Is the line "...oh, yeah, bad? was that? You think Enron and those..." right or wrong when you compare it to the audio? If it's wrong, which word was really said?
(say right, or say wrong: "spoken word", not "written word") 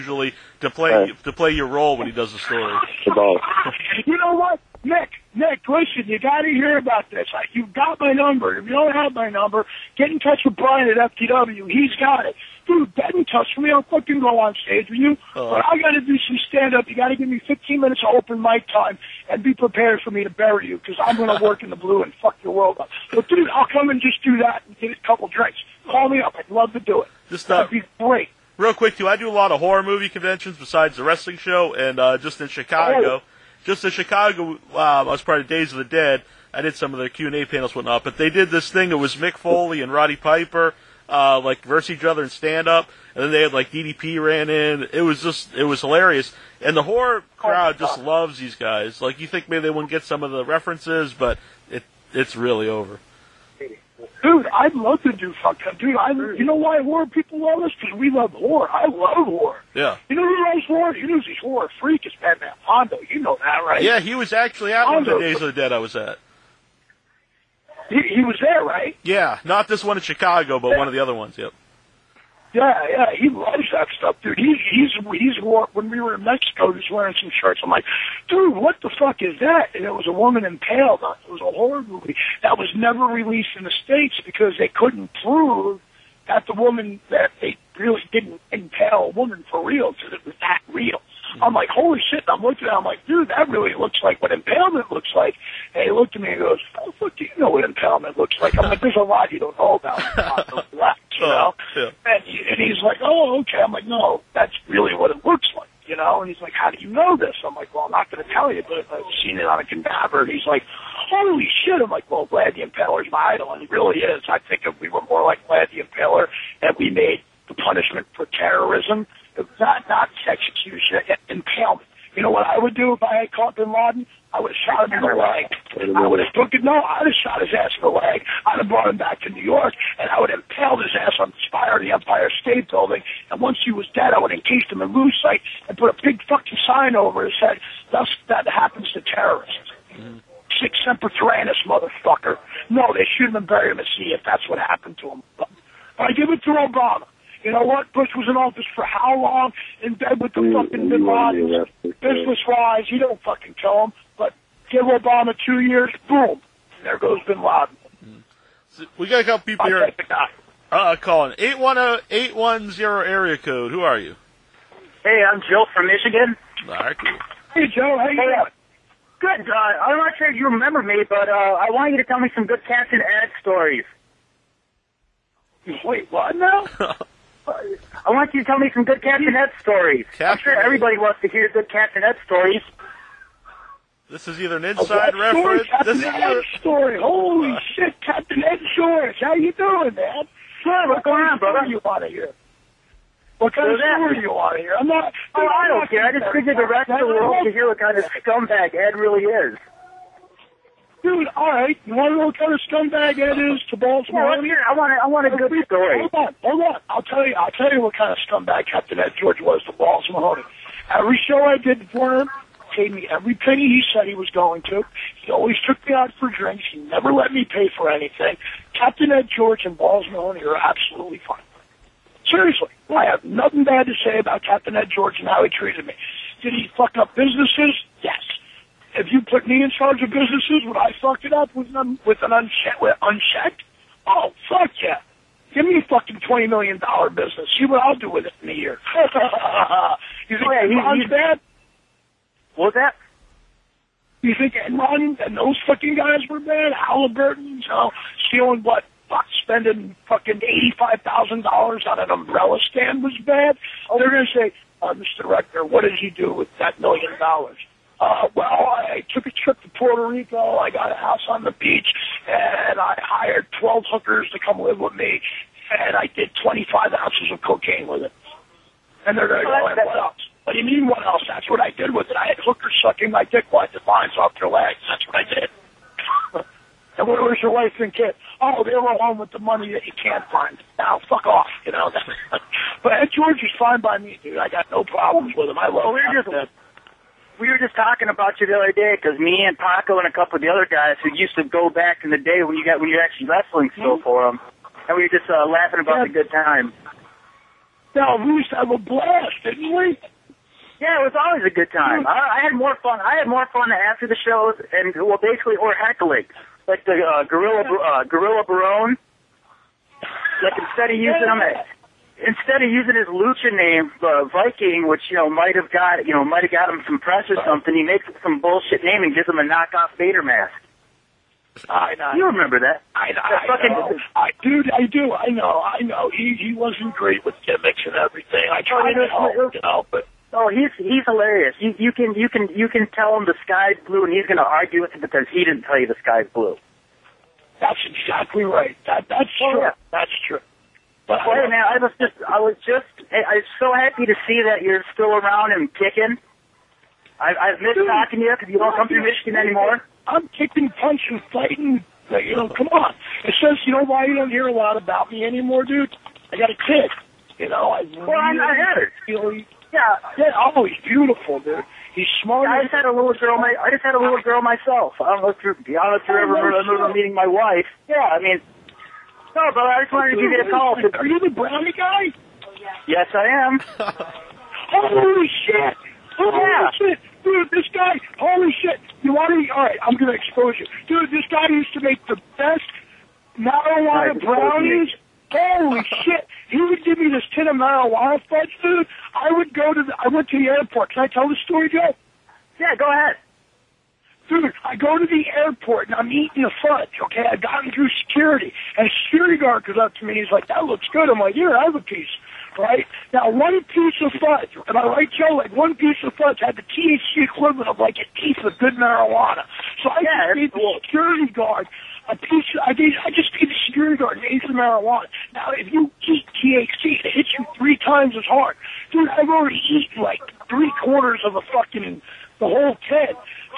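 right.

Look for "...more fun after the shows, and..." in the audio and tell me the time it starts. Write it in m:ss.
5:03.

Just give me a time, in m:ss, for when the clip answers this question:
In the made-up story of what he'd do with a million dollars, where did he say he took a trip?
4:19.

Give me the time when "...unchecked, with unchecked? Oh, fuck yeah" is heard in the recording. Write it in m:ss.
3:52.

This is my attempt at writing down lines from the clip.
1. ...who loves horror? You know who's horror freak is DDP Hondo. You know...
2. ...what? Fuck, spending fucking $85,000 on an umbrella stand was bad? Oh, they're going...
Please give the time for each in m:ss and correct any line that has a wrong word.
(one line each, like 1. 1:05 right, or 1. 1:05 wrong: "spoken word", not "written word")
1. 1:00 wrong: "Batman", not "DDP"
2. 4:08 right.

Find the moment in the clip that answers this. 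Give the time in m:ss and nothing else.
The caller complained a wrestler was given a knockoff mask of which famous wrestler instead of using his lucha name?
5:19.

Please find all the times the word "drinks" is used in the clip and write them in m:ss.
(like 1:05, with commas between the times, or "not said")
0:25, 3:36.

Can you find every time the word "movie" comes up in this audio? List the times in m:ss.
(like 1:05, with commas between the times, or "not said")
0:29, 1:21.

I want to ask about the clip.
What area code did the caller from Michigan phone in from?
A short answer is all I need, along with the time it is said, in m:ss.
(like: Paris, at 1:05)
810, at 2:41.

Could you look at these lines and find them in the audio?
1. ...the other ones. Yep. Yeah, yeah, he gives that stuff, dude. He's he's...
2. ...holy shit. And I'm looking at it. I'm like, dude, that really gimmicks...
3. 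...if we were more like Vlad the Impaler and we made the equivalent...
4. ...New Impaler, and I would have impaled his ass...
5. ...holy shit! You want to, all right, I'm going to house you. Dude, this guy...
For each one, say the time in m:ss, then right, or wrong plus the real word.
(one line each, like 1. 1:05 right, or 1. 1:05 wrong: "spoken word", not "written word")
1. 1:10 wrong: "loves", not "gives"
2. 1:31 wrong: "looks", not "gimmicks"
3. 1:54 wrong: "punishment", not "equivalent"
4. 2:09 wrong: "York", not "Impaler"
5. 6:18 wrong: "expose", not "house".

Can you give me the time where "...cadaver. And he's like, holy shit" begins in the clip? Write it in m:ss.
1:49.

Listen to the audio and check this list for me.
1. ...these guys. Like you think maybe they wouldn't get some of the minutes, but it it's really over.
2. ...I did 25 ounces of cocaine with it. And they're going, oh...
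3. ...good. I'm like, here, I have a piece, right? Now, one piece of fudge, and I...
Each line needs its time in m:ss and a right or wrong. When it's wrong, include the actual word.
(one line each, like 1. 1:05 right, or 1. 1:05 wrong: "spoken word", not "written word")
1. 0:48 wrong: "references", not "minutes"
2. 4:25 right
3. 6:40 right.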